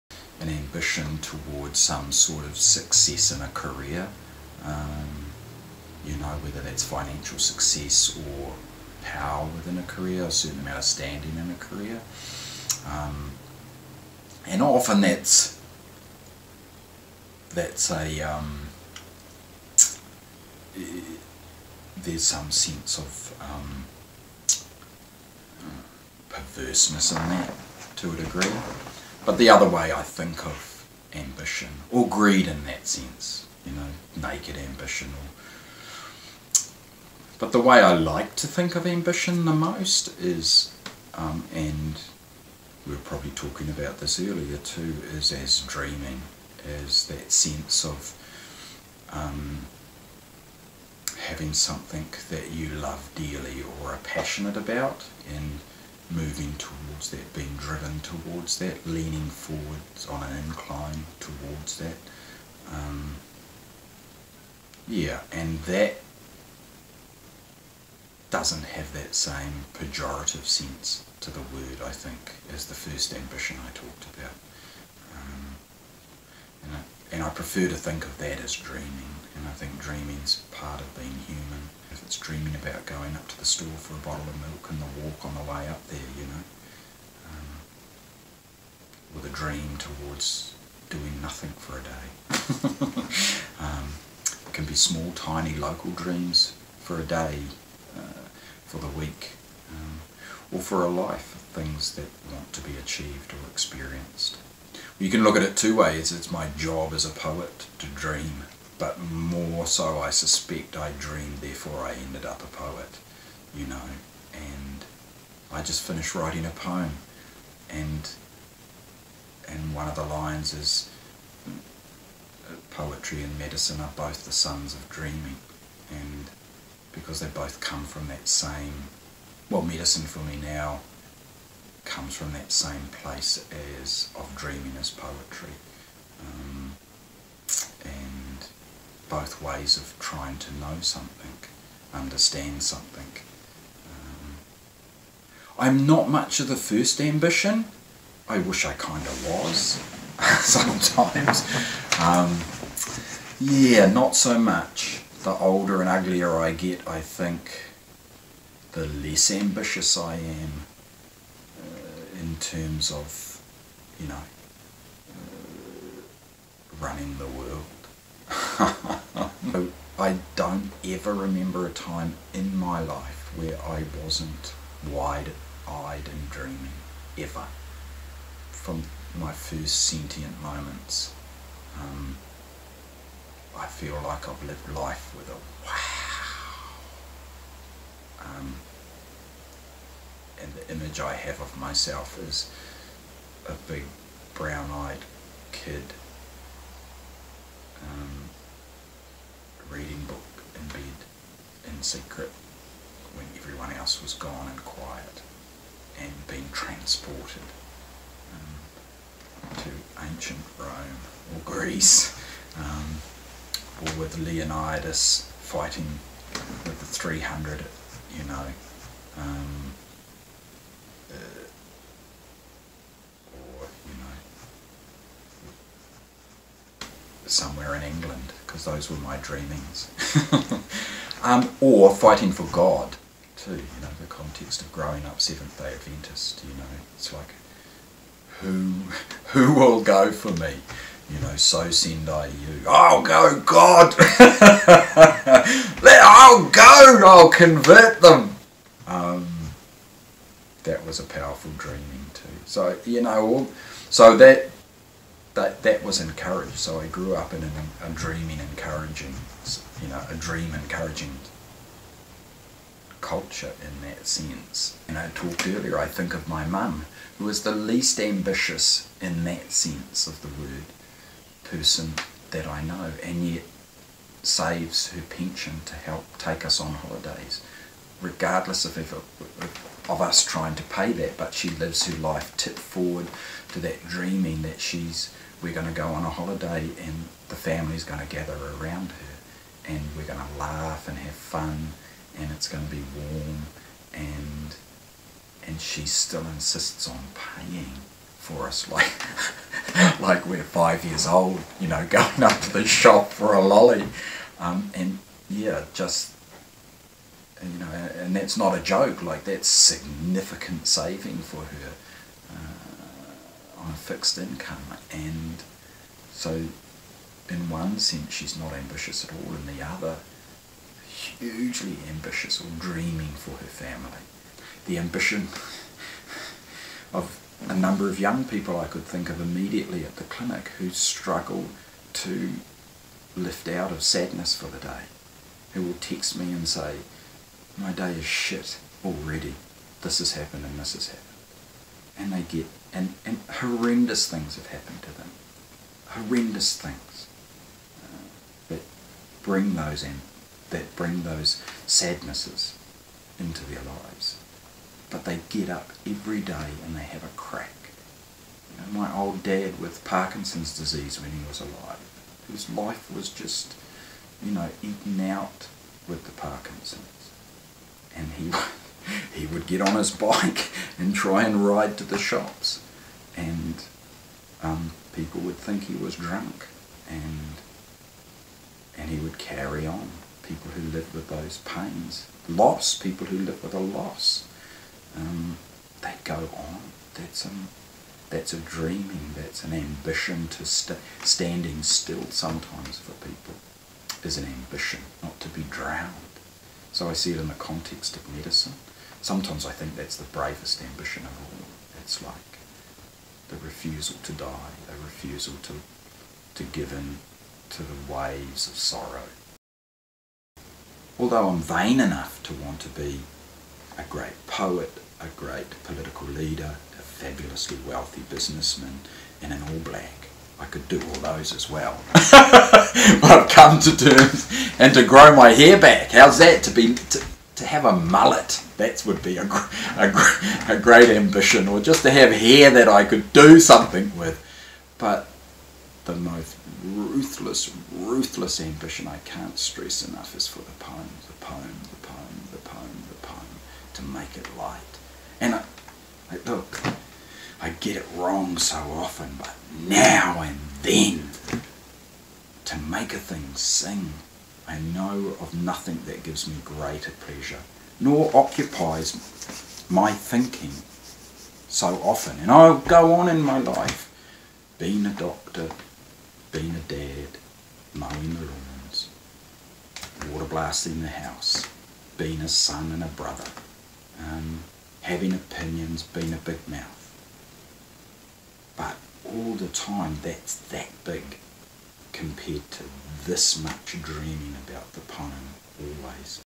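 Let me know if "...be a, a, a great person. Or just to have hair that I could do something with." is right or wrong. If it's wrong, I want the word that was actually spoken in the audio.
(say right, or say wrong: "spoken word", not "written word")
wrong: "ambition", not "person".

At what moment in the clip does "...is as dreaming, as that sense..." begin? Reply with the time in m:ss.
0:45.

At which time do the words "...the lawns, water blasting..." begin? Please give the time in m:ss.
7:48.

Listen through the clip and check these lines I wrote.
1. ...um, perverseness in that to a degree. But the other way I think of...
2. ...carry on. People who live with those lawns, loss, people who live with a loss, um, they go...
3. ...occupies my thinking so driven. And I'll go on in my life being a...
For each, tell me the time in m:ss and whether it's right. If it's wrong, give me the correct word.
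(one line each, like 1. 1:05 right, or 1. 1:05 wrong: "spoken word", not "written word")
1. 0:23 right
2. 6:19 wrong: "pains", not "lawns"
3. 7:38 wrong: "often", not "driven".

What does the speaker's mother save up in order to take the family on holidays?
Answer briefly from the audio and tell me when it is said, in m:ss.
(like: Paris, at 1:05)
her pension, at 4:34.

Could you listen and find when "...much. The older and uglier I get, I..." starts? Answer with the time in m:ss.
2:34.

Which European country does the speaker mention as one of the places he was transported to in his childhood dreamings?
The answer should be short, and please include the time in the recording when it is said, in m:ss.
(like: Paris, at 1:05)
England, at 3:47.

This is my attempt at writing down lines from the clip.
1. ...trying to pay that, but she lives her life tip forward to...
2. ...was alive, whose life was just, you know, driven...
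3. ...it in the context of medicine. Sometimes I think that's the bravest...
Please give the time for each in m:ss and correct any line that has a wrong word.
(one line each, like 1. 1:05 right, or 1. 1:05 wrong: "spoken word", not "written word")
1. 4:40 right
2. 6:01 wrong: "eaten", not "driven"
3. 6:37 right.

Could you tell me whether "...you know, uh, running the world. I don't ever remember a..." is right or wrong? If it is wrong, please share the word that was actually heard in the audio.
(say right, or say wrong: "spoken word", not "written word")
right.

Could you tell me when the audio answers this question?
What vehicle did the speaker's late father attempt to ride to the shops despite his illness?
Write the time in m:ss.
6:09.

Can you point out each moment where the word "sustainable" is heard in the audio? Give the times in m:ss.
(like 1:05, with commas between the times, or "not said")
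not said.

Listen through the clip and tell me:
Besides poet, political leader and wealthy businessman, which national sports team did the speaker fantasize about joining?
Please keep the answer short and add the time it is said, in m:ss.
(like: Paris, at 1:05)
All Black, at 6:59.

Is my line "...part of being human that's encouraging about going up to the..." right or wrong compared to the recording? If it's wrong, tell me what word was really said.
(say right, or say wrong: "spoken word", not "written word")
wrong: "dreaming", not "encouraging".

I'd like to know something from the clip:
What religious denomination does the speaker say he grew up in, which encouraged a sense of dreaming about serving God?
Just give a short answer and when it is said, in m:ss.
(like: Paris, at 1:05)
Seventh Day Adventist, at 3:55.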